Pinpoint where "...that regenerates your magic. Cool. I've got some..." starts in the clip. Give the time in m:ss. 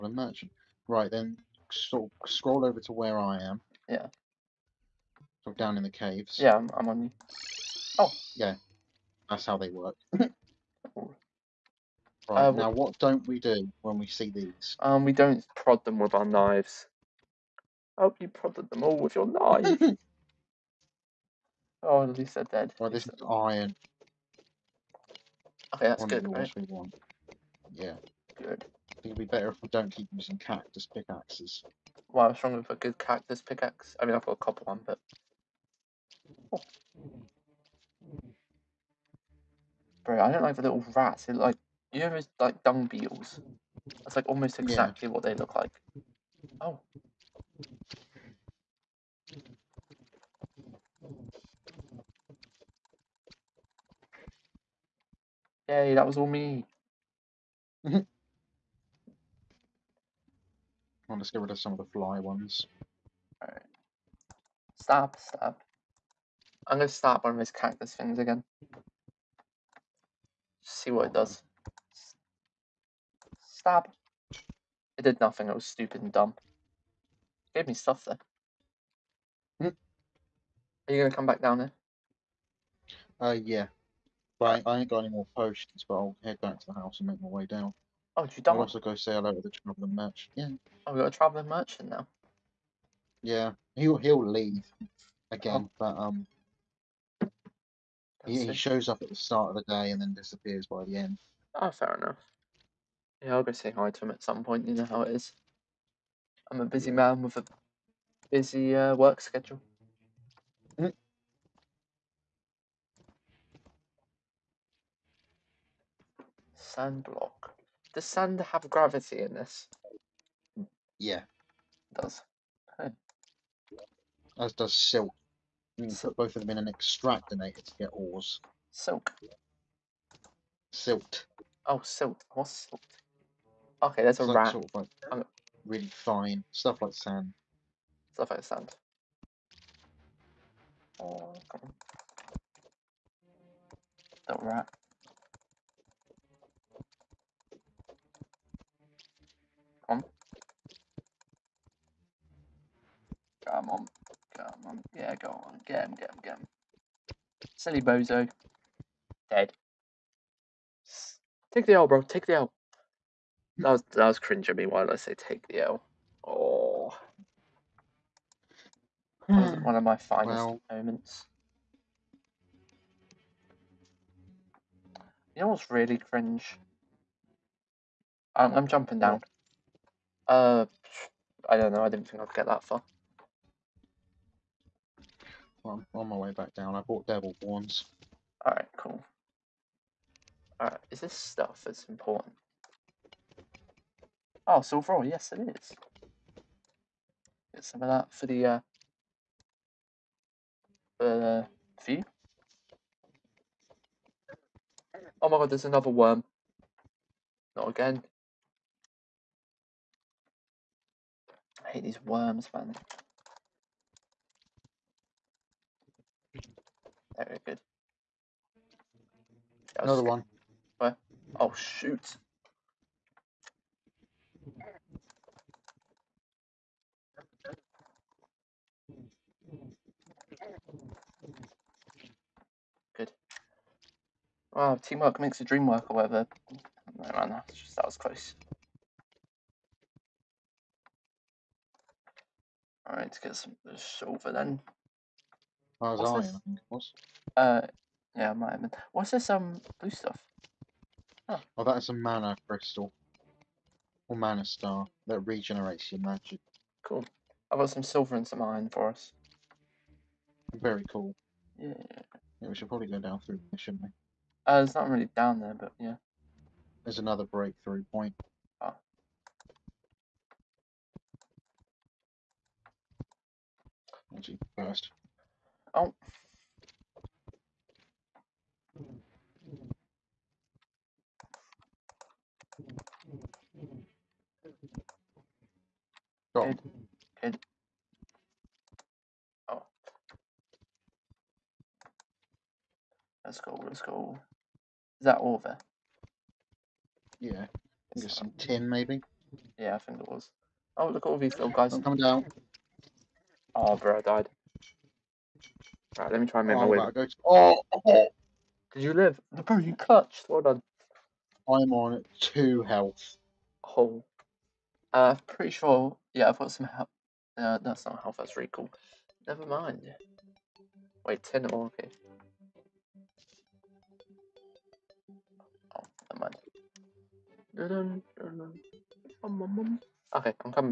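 4:15.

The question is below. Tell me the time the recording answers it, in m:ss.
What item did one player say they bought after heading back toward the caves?
3:07.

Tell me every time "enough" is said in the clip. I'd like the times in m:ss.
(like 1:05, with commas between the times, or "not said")
1:41.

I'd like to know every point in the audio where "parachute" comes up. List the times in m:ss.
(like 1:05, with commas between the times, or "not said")
not said.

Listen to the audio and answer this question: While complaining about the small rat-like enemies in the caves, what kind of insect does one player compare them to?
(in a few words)
Dung beetles.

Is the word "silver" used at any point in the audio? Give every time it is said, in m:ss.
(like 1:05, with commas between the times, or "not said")
3:14, 4:03, 4:17.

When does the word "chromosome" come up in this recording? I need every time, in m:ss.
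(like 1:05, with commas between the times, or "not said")
not said.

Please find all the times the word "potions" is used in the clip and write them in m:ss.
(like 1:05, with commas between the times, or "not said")
1:25.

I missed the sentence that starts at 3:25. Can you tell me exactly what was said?
Oh my god, there's another worm.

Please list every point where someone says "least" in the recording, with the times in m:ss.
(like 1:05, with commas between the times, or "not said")
0:22.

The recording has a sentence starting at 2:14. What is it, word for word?
Sort of like um, really fine stuff like sand.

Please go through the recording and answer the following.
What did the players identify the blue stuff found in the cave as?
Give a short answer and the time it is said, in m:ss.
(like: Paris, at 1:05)
Mana crystal, at 4:11.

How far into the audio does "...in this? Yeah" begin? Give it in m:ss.
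1:59.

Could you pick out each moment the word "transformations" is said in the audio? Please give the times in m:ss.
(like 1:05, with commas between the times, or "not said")
not said.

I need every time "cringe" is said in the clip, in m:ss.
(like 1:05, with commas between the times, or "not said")
2:44, 2:55.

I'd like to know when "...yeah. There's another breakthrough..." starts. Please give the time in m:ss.
4:25.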